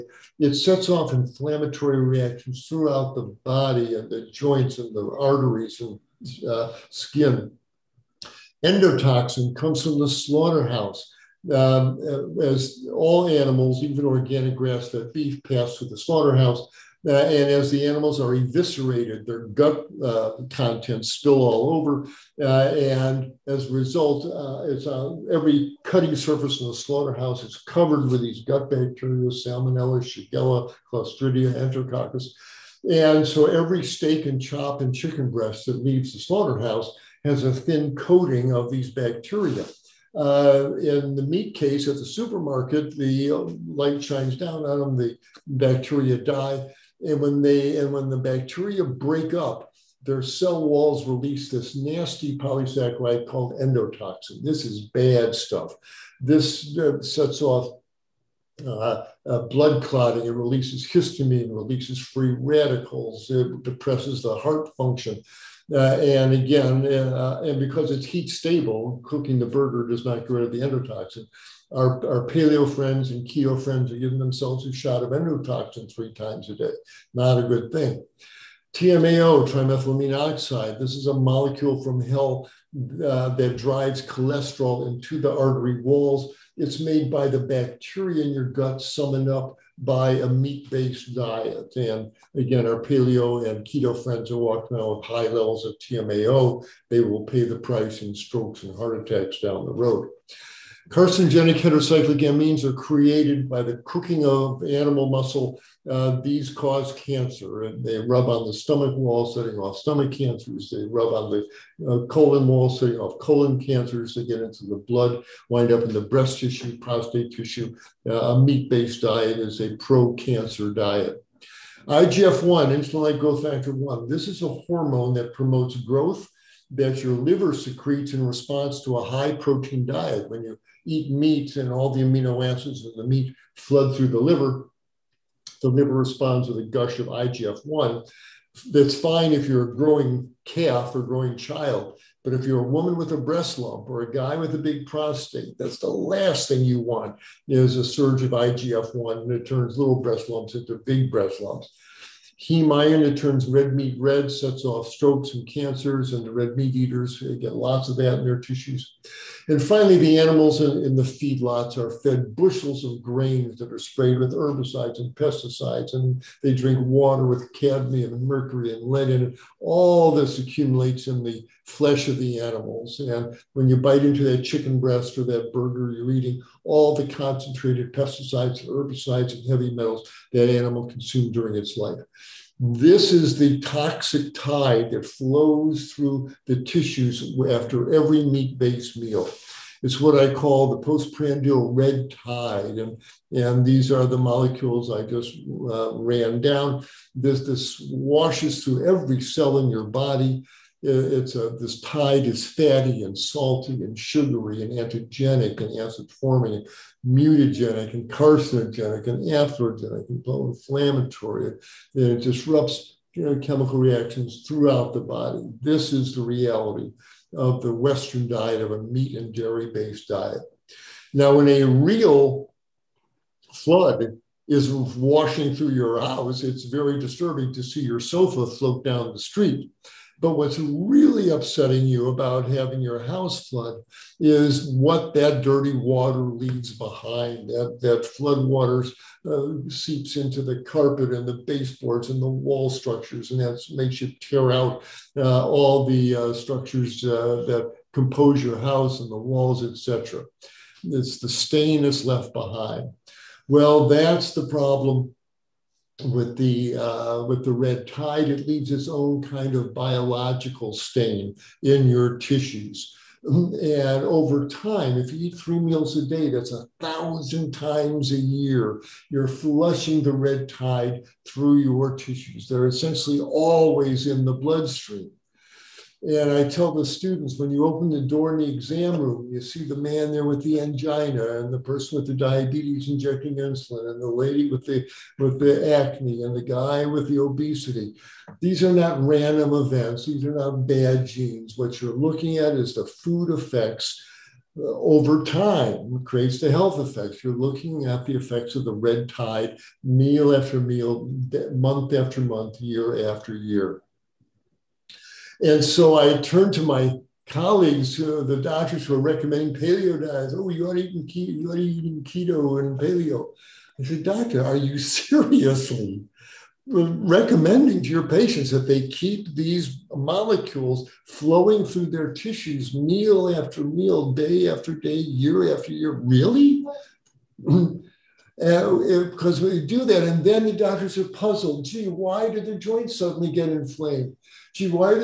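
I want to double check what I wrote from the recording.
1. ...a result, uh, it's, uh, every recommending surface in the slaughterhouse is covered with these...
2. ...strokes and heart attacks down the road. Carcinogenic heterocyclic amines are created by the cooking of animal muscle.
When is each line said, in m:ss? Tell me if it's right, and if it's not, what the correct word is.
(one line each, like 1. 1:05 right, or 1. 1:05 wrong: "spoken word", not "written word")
1. 0:23 wrong: "cutting", not "recommending"
2. 1:38 right.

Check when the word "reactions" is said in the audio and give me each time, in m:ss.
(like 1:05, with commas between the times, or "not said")
0:01, 3:33.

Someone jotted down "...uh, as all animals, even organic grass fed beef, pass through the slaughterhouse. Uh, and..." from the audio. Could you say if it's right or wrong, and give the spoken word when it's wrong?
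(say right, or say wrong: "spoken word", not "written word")
right.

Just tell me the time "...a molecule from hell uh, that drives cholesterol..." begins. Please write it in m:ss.
1:21.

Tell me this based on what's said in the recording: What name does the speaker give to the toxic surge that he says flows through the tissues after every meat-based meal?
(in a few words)
Postprandial red tide.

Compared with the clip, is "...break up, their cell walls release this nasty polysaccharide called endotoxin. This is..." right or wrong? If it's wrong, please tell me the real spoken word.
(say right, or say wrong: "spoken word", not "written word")
right.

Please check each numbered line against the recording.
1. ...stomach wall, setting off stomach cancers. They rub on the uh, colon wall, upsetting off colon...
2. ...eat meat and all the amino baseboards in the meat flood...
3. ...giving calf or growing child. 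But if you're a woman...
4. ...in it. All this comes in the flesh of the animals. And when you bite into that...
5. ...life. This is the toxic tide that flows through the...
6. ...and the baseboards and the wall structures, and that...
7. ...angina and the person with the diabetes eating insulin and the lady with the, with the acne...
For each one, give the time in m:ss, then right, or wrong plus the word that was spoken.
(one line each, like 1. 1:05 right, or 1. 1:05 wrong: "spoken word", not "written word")
1. 1:48 wrong: "setting", not "upsetting"
2. 2:10 wrong: "acids", not "baseboards"
3. 2:19 wrong: "growing", not "giving"
4. 2:49 wrong: "accumulates", not "comes"
5. 3:01 right
6. 4:01 right
7. 4:40 wrong: "injecting", not "eating".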